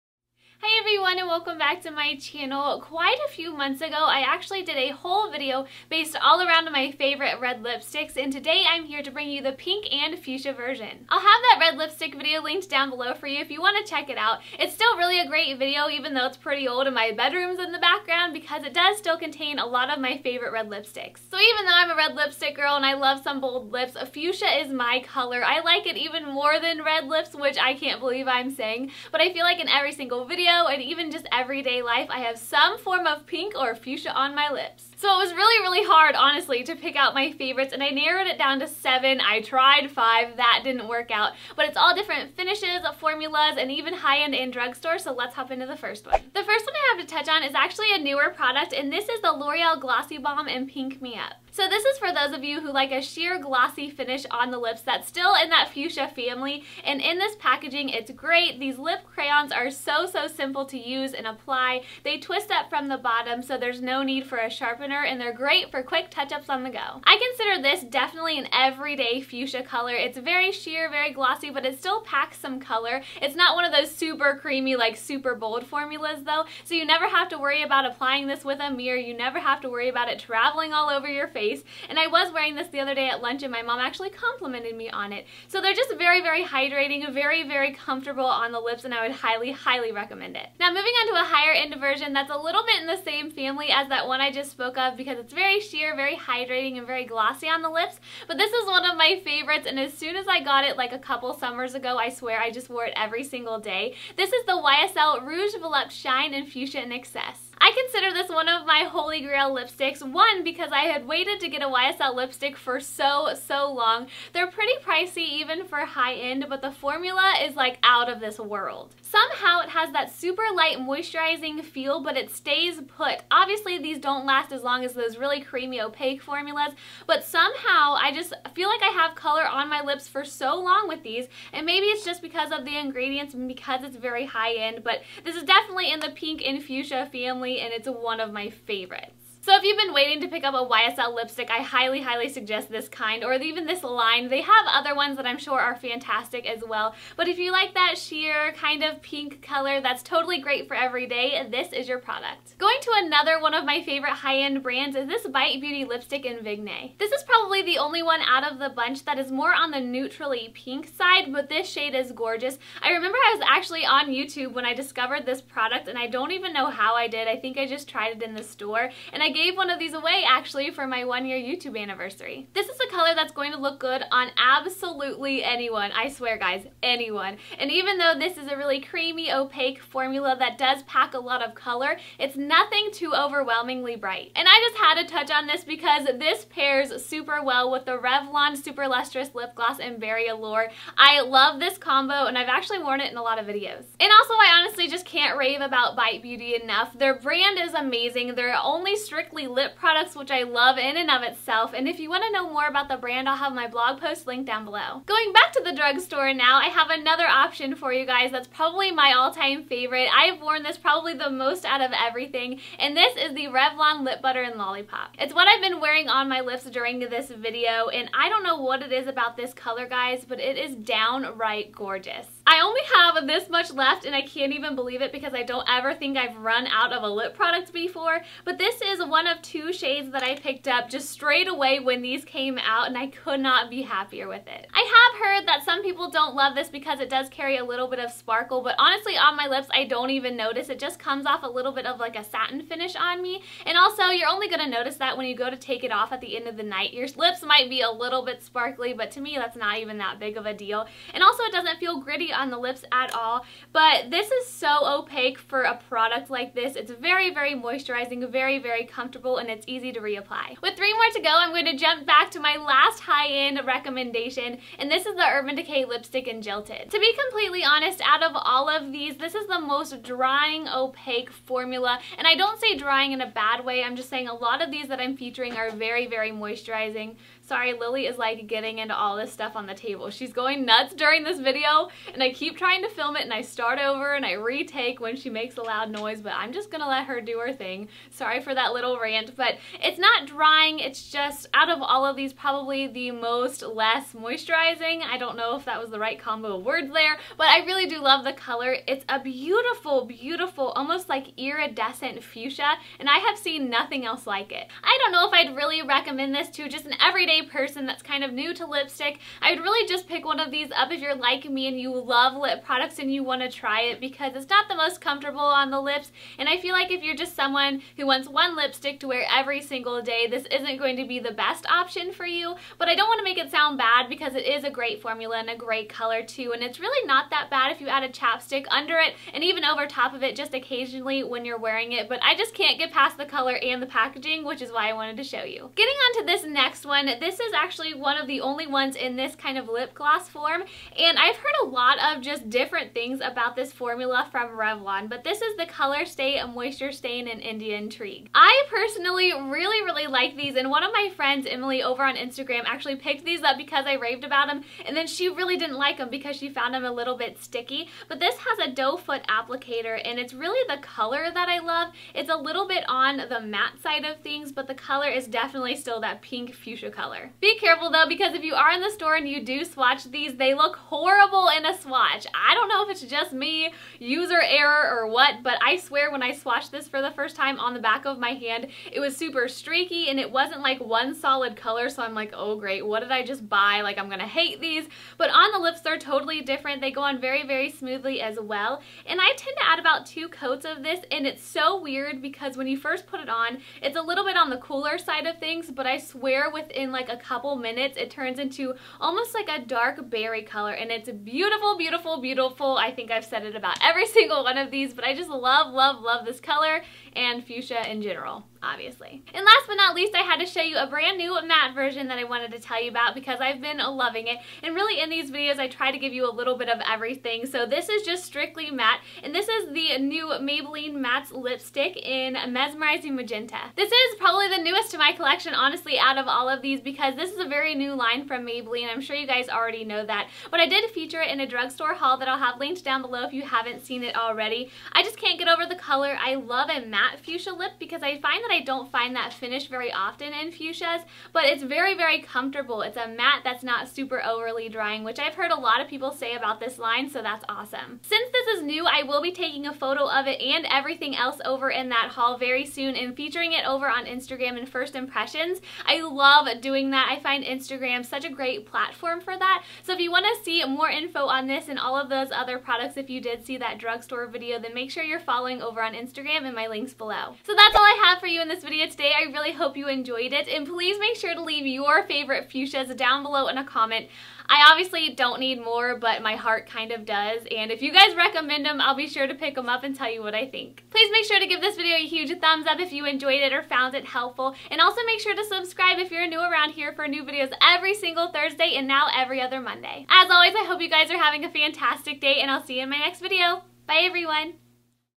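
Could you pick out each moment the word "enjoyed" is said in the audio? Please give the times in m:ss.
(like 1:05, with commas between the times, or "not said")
7:49, 8:03.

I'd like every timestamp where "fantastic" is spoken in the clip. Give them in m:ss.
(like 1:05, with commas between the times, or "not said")
2:25, 8:11.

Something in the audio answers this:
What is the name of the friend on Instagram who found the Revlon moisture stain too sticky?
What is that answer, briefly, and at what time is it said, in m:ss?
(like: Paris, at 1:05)
Emily, at 5:51.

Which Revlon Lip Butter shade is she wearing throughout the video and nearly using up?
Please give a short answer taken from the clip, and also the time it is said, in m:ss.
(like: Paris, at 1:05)
Lollipop, at 3:34.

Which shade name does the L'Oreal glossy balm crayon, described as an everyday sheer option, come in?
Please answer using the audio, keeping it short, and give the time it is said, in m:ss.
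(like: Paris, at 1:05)
Pink Me Up, at 0:50.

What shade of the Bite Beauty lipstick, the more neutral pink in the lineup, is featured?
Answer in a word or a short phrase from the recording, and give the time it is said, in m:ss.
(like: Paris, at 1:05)
Vigne, at 2:36.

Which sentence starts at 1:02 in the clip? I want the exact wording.
They twist up from the bottom, so there's no need for a sharpener, and they're great for quick touch-ups on the go.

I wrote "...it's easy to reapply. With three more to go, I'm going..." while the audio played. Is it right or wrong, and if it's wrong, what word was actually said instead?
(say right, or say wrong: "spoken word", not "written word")
right.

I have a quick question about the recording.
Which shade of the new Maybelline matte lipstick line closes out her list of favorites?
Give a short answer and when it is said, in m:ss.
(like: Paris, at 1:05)
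Mesmerizing Magenta, at 7:02.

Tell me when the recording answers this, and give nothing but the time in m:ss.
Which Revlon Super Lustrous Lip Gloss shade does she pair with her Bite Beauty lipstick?
3:09.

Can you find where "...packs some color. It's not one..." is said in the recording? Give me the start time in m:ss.
1:12.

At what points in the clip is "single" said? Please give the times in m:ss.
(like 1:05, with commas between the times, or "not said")
0:29, 1:43, 5:19, 6:44, 8:07.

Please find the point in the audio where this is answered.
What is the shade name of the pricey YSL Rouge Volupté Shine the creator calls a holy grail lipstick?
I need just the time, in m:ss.
1:46.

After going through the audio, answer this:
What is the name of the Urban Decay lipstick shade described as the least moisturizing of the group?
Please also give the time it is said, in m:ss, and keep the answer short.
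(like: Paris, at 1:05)
Jilted, at 4:26.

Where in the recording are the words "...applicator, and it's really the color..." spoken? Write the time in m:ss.
5:59.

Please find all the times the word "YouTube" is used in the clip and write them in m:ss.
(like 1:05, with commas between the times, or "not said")
2:44, 2:51.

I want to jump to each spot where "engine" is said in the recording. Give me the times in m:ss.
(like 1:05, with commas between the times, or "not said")
not said.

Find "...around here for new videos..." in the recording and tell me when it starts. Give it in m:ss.
8:06.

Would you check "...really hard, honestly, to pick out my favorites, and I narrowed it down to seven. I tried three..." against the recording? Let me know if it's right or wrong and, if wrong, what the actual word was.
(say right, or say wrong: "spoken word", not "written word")
wrong: "five", not "three".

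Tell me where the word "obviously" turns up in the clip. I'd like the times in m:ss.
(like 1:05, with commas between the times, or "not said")
2:03, 6:48, 7:54.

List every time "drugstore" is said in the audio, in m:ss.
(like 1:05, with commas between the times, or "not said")
0:44, 3:25, 7:11, 7:43.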